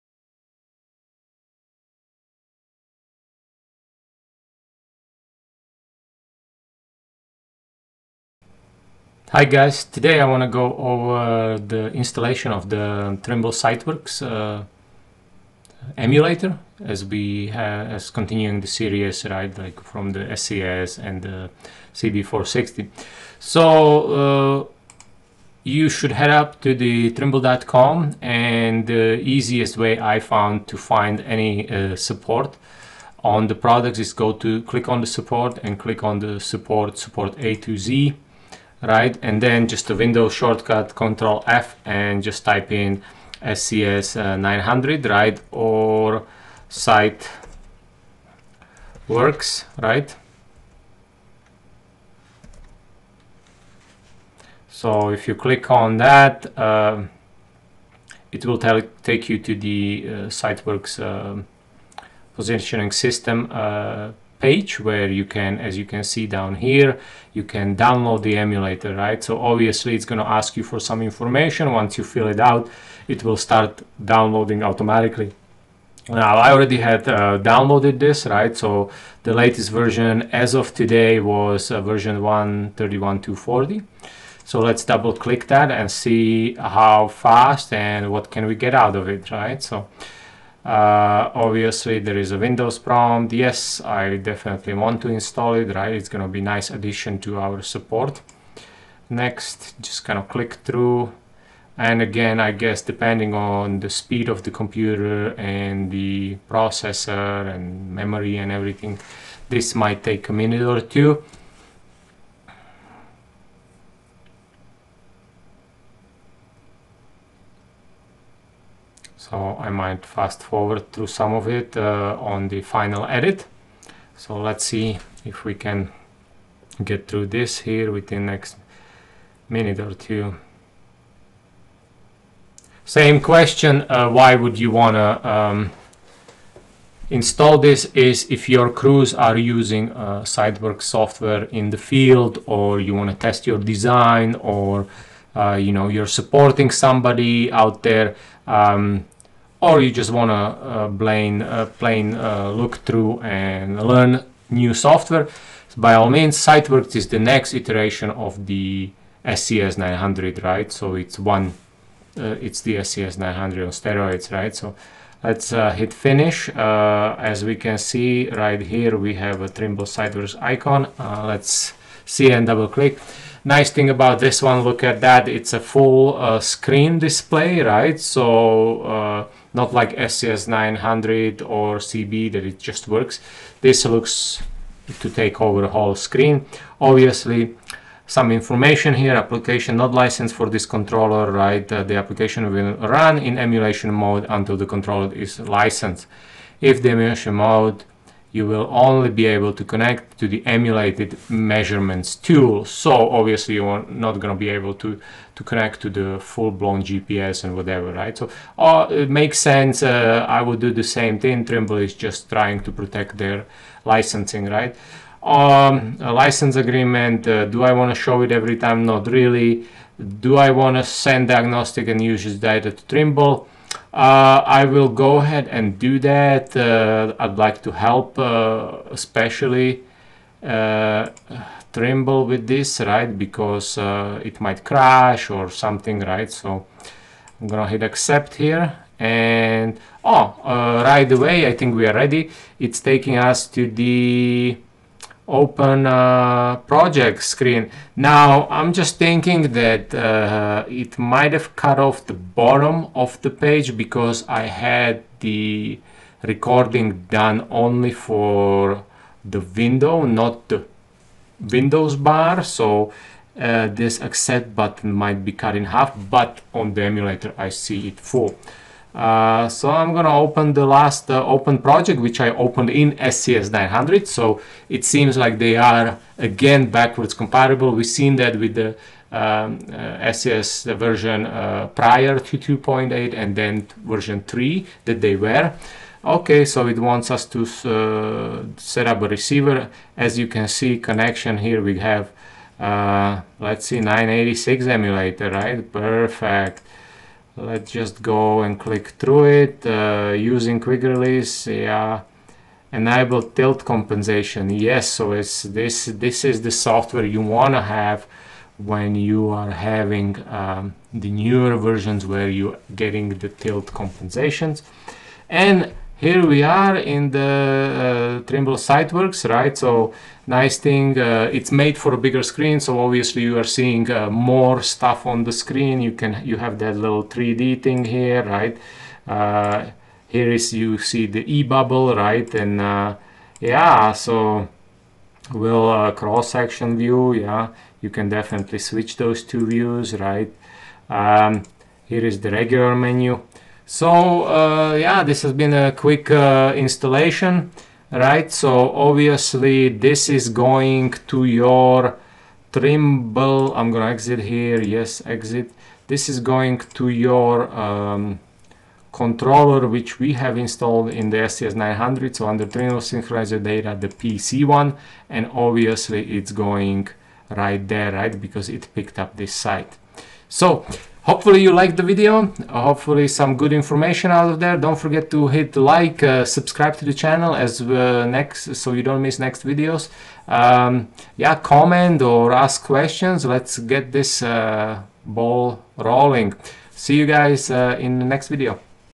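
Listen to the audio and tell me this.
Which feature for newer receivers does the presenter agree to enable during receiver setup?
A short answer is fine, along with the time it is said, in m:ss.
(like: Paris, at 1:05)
Tilt compensation, at 5:03.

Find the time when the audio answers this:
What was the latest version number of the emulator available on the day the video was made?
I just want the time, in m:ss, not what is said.
1:22.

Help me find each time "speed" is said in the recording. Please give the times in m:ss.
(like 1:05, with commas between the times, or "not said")
1:43.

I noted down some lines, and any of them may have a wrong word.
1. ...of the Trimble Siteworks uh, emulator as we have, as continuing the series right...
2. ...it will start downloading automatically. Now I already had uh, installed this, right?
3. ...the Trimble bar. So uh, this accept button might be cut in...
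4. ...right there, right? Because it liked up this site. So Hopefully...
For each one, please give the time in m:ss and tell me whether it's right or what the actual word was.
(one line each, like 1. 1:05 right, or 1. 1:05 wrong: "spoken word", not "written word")
1. 0:12 right
2. 1:13 wrong: "downloaded", not "installed"
3. 4:20 wrong: "Windows", not "Trimble"
4. 6:07 wrong: "picked", not "liked".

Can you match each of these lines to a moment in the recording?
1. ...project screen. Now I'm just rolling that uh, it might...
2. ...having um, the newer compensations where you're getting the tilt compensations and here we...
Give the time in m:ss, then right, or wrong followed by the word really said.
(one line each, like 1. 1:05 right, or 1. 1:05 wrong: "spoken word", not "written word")
1. 4:06 wrong: "thinking", not "rolling"
2. 5:09 wrong: "versions", not "compensations".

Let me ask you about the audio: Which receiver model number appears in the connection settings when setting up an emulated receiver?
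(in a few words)
986.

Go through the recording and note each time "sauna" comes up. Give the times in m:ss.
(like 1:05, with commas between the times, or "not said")
not said.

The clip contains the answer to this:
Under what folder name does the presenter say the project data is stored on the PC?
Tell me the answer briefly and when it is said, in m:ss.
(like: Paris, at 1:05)
Trimble Synchronizer Data, at 6:02.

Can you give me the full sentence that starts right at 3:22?
So obviously you're not going to be able to, to connect to the full-blown GPS and whatever, right?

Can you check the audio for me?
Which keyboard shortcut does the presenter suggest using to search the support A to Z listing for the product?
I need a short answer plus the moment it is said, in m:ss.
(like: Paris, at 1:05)
Control F, at 0:40.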